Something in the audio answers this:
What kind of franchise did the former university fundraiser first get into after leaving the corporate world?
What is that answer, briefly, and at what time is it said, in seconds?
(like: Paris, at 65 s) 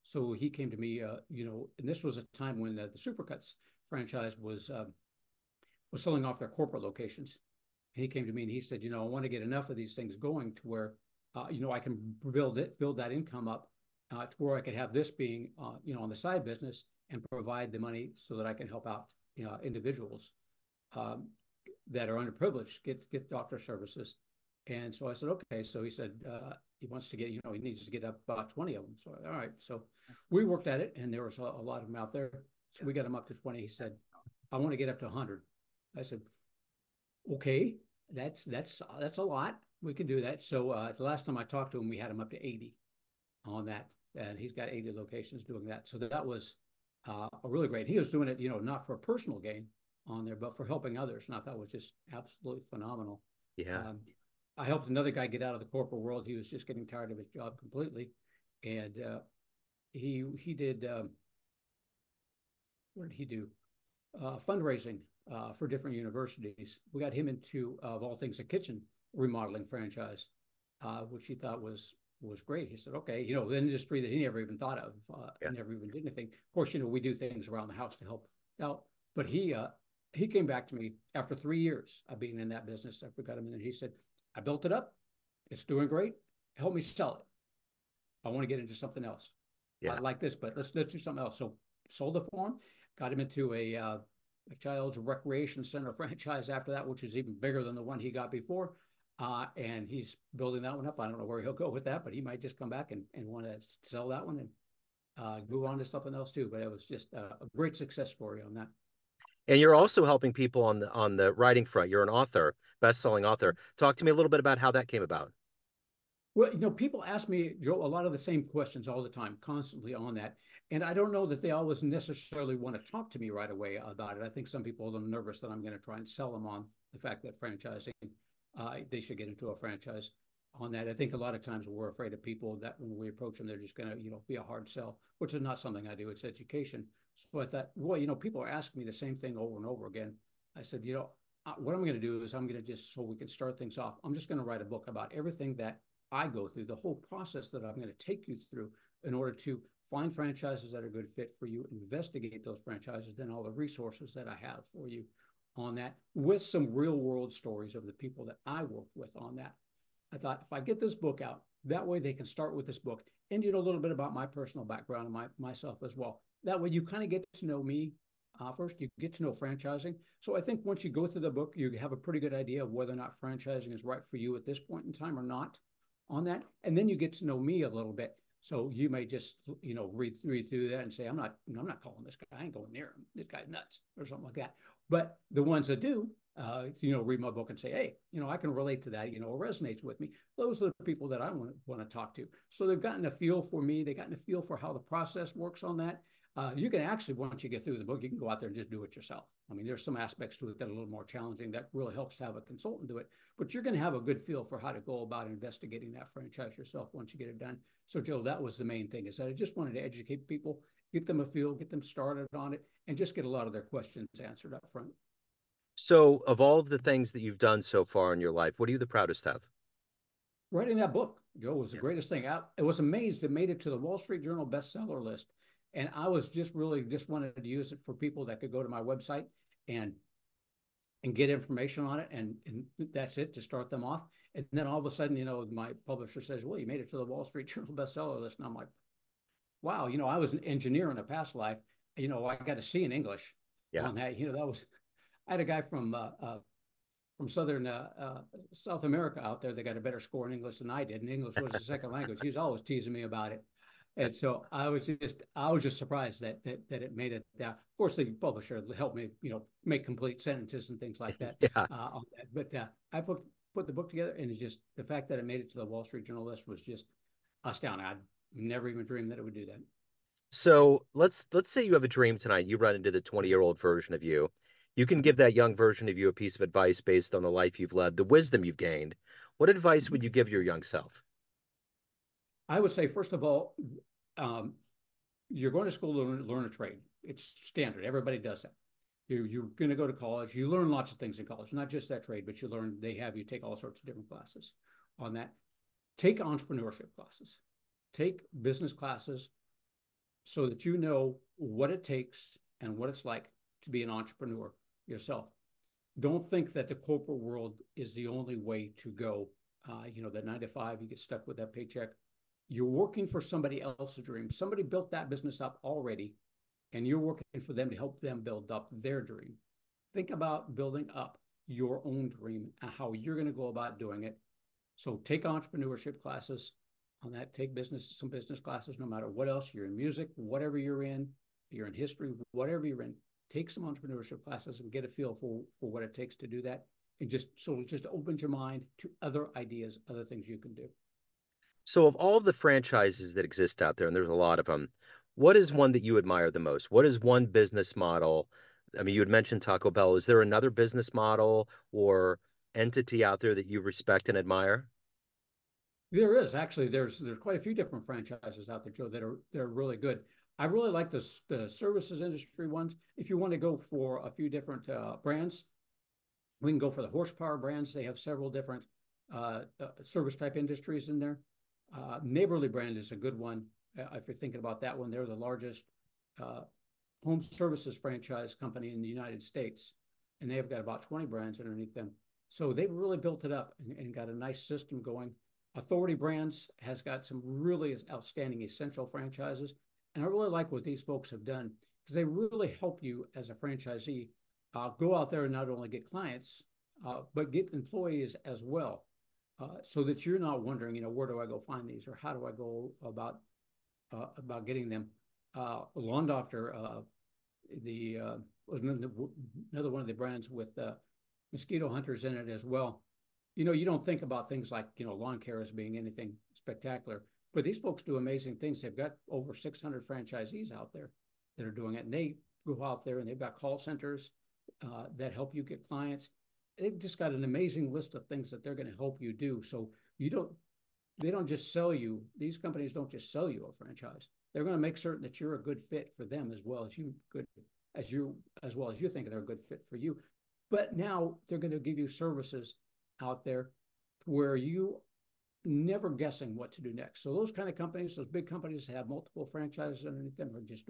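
Kitchen remodeling, at 68 s.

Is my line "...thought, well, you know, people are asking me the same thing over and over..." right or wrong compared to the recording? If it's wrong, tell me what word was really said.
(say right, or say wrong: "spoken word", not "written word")
right.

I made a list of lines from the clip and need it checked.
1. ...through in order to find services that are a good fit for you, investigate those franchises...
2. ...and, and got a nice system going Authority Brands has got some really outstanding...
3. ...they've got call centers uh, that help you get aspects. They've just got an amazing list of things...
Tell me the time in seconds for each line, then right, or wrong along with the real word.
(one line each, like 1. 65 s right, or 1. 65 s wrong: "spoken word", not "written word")
1. 148 s wrong: "franchises", not "services"
2. 383 s right
3. 423 s wrong: "clients", not "aspects".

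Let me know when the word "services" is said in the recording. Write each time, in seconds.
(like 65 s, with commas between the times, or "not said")
23 s, 361 s, 369 s, 377 s, 441 s.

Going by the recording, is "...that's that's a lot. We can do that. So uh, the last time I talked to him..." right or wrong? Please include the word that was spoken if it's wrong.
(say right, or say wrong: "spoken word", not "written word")
right.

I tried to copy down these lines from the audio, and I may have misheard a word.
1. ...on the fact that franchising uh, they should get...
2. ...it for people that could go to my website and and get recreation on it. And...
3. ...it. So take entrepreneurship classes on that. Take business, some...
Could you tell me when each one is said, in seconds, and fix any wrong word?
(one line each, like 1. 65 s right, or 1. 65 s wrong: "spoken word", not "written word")
1. 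126 s right
2. 227 s wrong: "information", not "recreation"
3. 324 s right.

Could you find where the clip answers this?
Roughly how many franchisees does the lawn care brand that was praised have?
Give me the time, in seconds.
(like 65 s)
419 s.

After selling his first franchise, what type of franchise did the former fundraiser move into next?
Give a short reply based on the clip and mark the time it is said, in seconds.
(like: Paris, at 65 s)
Child's recreation center, at 94 s.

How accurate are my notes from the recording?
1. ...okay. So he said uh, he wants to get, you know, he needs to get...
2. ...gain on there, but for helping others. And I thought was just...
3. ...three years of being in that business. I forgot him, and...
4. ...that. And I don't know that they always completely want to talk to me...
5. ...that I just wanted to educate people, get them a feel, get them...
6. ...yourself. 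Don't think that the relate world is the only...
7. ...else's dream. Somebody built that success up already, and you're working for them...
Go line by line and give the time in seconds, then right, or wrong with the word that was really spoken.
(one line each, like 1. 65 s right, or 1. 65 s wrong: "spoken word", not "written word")
1. 25 s right
2. 49 s right
3. 81 s right
4. 120 s wrong: "necessarily", not "completely"
5. 209 s right
6. 304 s wrong: "corporate", not "relate"
7. 313 s wrong: "business", not "success".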